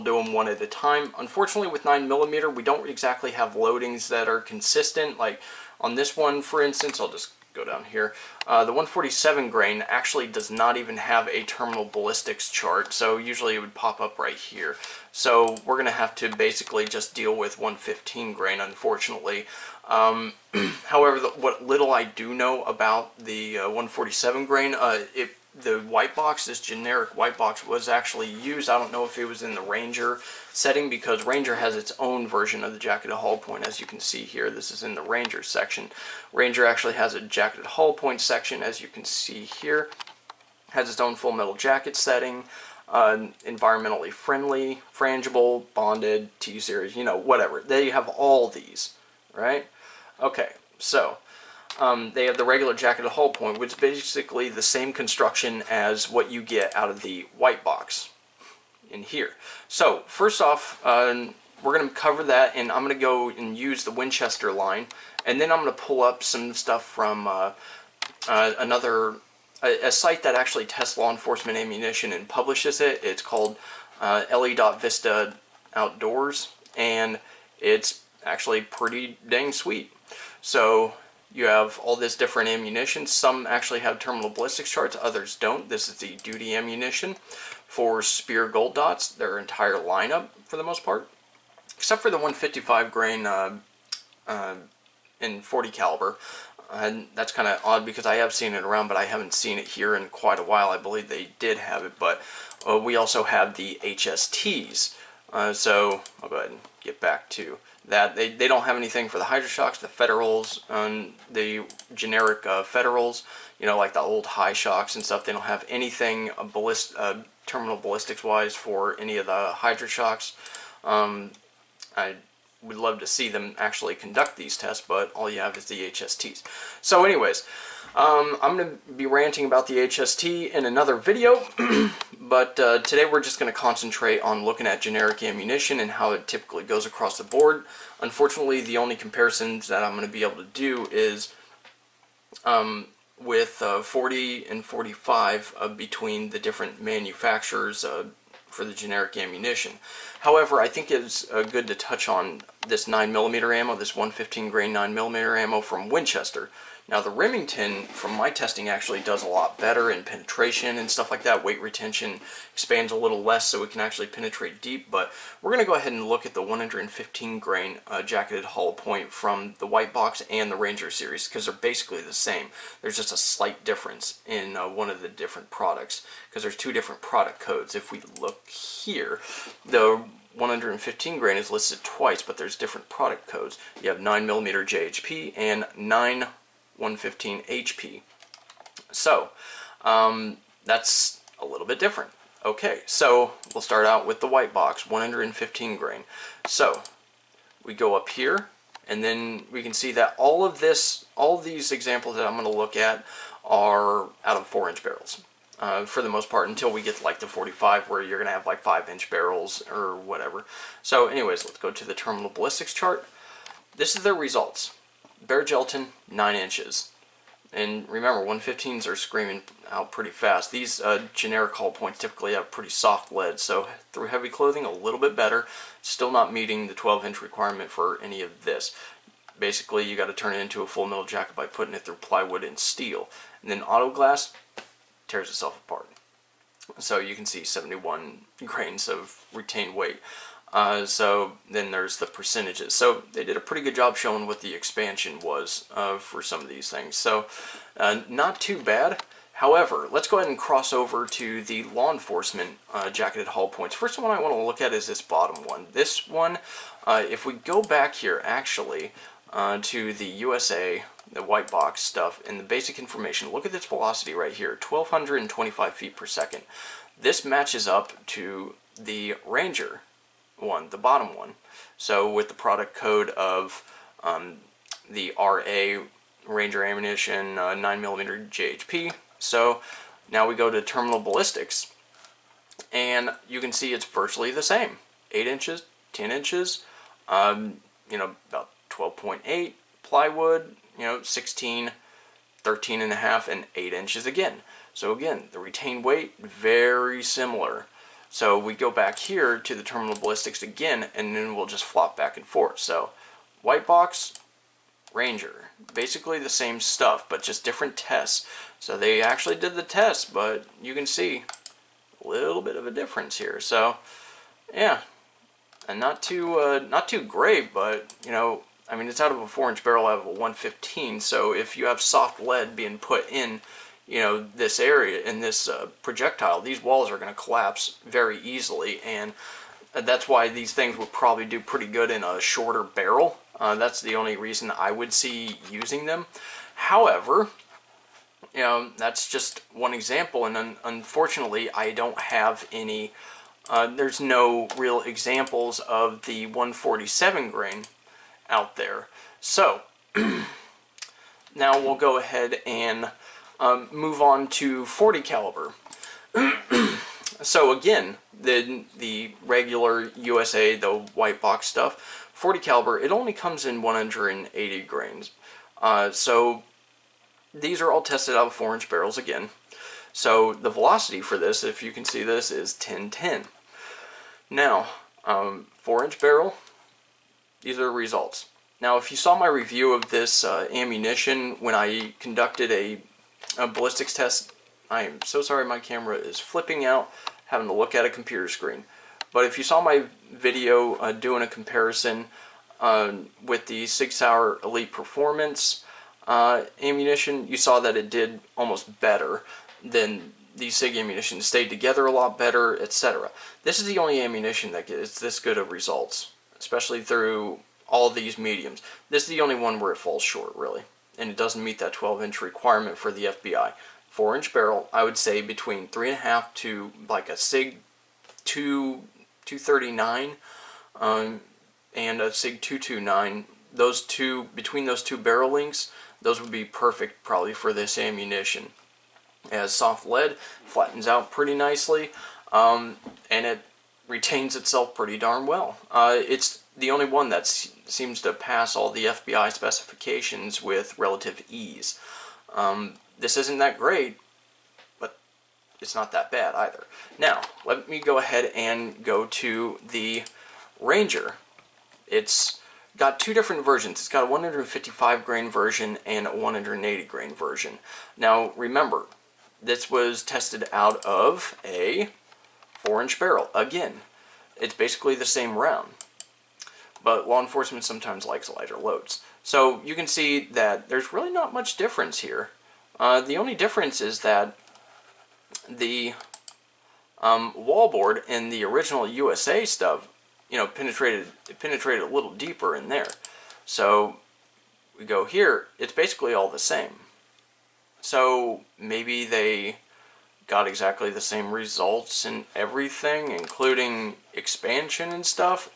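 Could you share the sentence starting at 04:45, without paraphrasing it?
8 inches, 10 inches, um, you know, about 12.8 plywood, you know, 16, 13 and a half, and 8 inches again.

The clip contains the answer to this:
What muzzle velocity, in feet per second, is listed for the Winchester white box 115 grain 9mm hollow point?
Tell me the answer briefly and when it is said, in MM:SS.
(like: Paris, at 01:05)
1,225, at 04:24.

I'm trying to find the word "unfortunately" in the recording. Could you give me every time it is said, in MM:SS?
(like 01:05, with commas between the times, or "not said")
00:01, 00:18, 02:17, 05:40.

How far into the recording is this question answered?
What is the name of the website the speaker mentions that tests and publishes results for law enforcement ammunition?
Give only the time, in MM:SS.
01:14.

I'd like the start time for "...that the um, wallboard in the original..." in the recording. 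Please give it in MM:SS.
07:54.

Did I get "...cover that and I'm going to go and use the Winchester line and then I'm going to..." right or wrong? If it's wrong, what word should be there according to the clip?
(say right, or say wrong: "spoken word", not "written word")
right.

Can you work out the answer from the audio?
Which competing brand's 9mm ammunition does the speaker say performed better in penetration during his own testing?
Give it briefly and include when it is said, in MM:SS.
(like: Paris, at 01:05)
Remington, at 02:37.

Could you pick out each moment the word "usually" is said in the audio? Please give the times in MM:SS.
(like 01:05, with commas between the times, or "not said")
00:13.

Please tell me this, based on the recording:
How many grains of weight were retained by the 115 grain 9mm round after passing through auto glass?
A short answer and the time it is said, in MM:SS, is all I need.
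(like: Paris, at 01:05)
71, at 03:57.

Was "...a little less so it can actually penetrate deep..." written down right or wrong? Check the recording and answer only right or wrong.
right.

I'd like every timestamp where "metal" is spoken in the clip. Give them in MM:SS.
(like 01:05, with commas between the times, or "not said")
00:41, 03:50.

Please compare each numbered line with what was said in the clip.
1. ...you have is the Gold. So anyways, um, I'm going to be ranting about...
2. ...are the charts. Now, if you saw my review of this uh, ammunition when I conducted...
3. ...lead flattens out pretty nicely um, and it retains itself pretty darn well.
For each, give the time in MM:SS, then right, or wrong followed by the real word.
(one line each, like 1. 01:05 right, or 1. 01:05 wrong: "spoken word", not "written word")
1. 02:05 wrong: "HSTs", not "Gold"
2. 06:17 wrong: "results", not "charts"
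3. 07:09 right.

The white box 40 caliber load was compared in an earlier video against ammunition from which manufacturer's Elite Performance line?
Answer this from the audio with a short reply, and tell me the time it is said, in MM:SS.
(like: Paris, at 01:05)
SIG Sauer, at 06:33.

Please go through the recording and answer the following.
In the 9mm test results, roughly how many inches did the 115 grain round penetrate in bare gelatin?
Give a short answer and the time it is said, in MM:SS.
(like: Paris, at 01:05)
9 inches, at 03:36.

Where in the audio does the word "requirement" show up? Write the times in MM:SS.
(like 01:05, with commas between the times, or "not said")
03:47, 06:52.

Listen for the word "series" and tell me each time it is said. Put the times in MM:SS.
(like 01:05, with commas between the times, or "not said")
00:46, 02:50.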